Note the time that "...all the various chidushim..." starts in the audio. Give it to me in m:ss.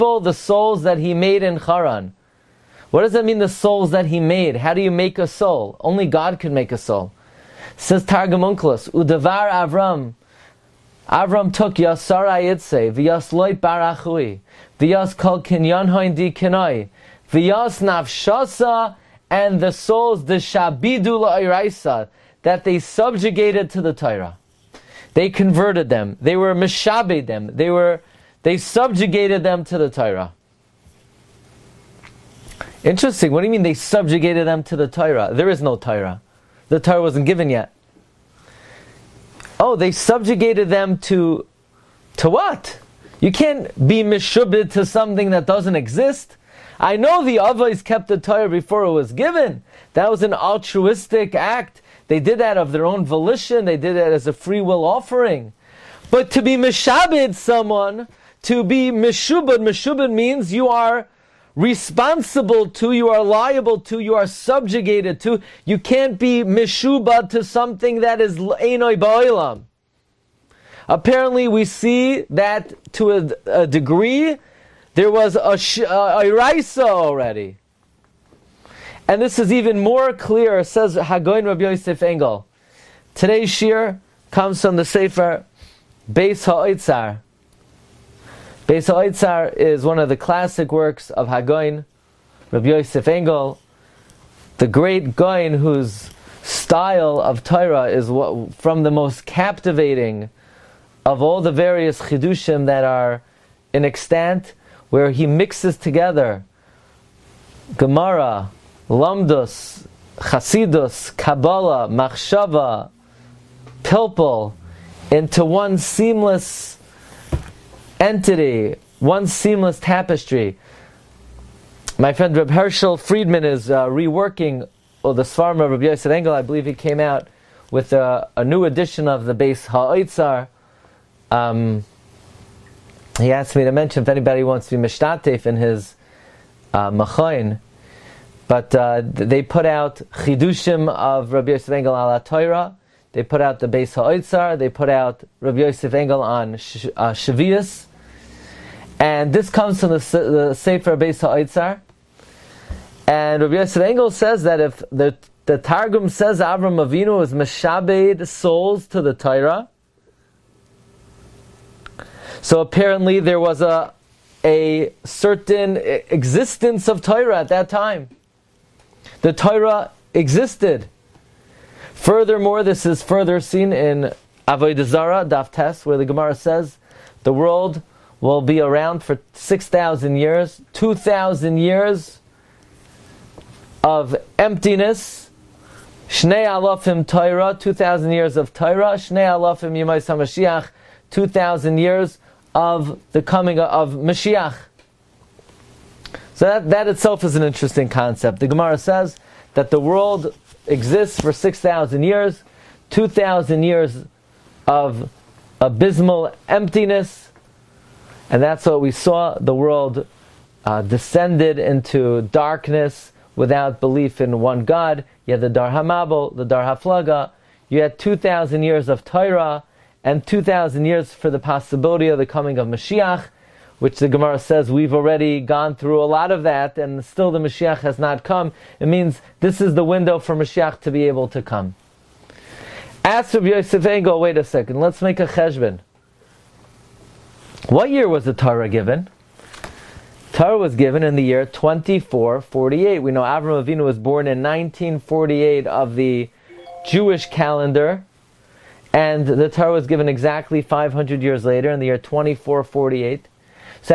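1:41.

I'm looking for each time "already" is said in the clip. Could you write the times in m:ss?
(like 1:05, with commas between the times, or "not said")
1:16, 3:44.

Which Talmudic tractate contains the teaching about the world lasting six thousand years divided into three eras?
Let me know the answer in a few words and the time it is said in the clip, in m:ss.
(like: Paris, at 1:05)
Avodah Zarah, at 2:54.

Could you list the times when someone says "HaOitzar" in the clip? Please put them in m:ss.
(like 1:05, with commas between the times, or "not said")
1:26, 2:23, 2:31.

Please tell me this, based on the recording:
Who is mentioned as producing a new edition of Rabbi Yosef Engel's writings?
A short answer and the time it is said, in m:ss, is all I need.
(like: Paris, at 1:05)
Herschel Friedman, at 2:02.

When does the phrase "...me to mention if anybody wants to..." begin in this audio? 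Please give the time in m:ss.
2:13.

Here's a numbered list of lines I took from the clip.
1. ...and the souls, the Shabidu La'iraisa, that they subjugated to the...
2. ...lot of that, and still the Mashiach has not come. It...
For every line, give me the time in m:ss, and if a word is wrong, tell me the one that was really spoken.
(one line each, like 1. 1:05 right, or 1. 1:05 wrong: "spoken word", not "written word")
1. 0:19 right
2. 3:46 right.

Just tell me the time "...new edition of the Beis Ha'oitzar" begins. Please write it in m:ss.
2:08.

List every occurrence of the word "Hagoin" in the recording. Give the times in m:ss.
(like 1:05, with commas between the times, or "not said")
1:20, 1:31.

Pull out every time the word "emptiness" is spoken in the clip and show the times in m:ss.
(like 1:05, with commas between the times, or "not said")
3:04, 3:26.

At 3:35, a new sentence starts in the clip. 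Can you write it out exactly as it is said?
You had the Dar Hamabel, the Dar Haflaga.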